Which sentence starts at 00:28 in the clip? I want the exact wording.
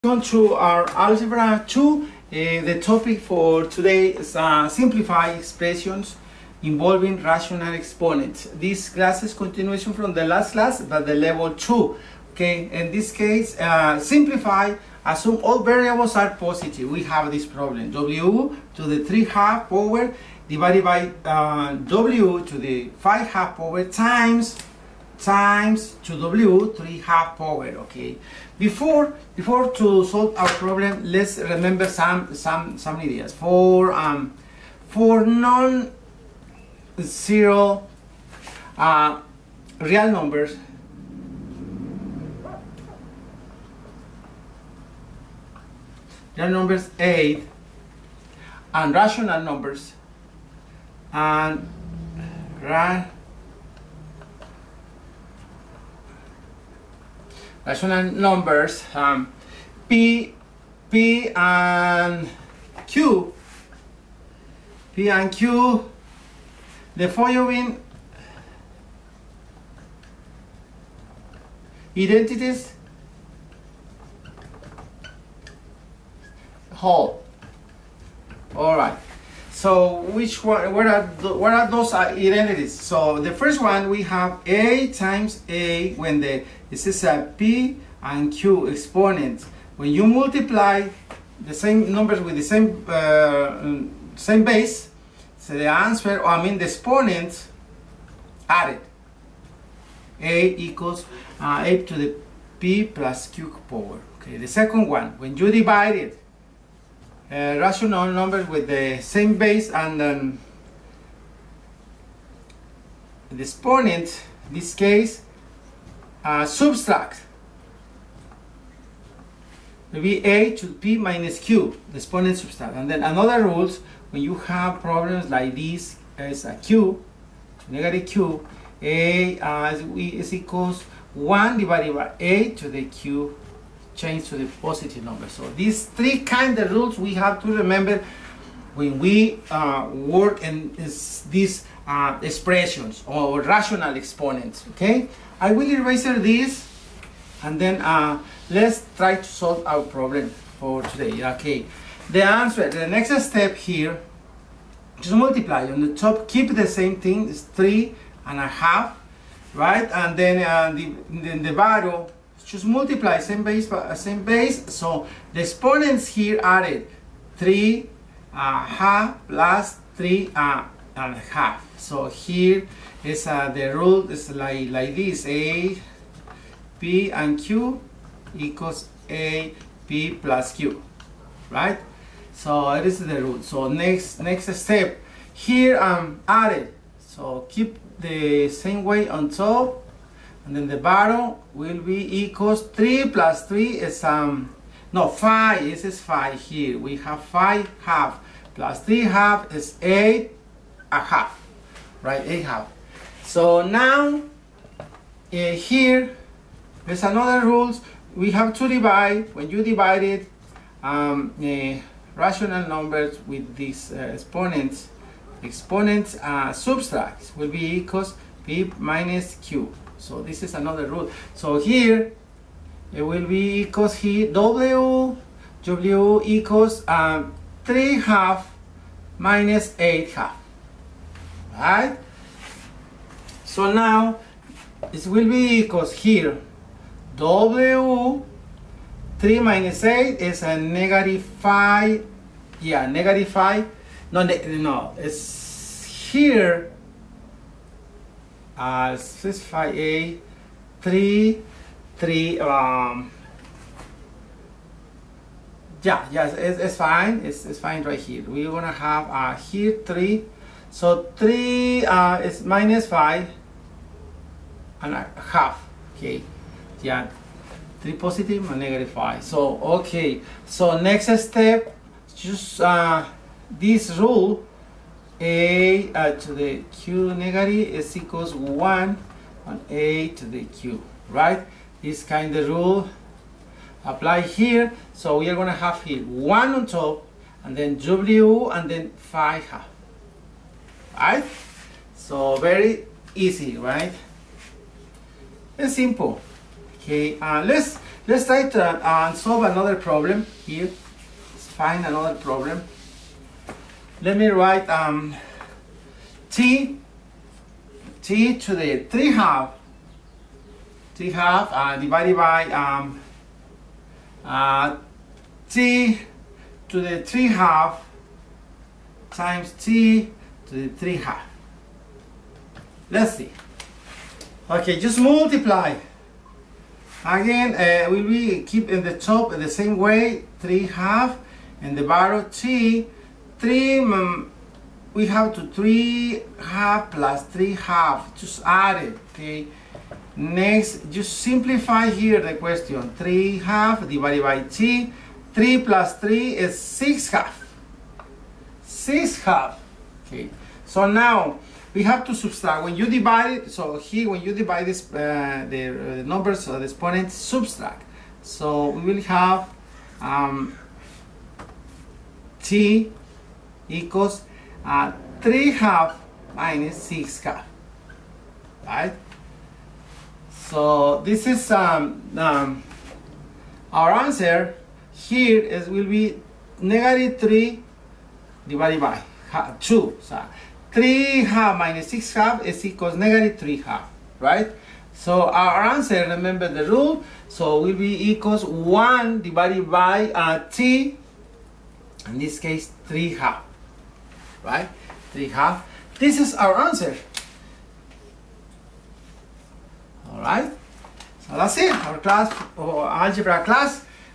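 Before, before to solve our problem, let's remember some, some, some ideas.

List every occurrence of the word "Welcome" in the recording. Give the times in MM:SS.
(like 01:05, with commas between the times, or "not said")
00:00.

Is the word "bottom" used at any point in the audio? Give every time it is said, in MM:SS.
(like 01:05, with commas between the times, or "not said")
02:41, 03:10, 05:31.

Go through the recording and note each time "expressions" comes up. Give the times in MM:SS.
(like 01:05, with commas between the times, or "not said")
00:05, 02:22.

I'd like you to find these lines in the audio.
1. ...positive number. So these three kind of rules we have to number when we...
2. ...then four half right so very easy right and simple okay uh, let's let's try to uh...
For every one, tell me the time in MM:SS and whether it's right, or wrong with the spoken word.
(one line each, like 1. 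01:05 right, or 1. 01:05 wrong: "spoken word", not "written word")
1. 02:14 wrong: "remember", not "number"
2. 04:48 wrong: "five", not "four".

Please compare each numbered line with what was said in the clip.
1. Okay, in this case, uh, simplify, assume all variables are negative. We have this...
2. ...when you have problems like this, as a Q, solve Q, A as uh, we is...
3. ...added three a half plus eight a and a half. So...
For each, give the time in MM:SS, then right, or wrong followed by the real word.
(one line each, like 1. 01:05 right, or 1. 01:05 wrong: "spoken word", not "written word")
1. 00:12 wrong: "positive", not "negative"
2. 02:04 wrong: "negative", not "solve"
3. 02:46 wrong: "three", not "eight".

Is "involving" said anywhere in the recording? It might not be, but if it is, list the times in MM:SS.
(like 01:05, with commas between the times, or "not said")
00:06.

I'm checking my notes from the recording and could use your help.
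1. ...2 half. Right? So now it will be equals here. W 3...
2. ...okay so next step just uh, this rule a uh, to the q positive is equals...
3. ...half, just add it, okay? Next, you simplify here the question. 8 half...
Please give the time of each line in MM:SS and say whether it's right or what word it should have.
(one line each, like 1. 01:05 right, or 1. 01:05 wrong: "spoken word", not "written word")
1. 03:49 wrong: "8", not "2"
2. 04:29 wrong: "negative", not "positive"
3. 05:37 wrong: "3", not "8".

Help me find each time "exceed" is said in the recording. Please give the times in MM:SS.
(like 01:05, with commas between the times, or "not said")
not said.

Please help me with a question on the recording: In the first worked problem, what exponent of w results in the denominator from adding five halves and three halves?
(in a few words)
8/2.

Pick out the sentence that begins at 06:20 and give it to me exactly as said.
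So 3 half minus 6 half is equals negative 3 half, right?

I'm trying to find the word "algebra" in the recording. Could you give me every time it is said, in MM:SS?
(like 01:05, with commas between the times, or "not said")
00:00, 06:42.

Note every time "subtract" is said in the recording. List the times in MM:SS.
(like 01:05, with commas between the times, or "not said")
01:56, 02:02, 03:36, 05:52, 05:57.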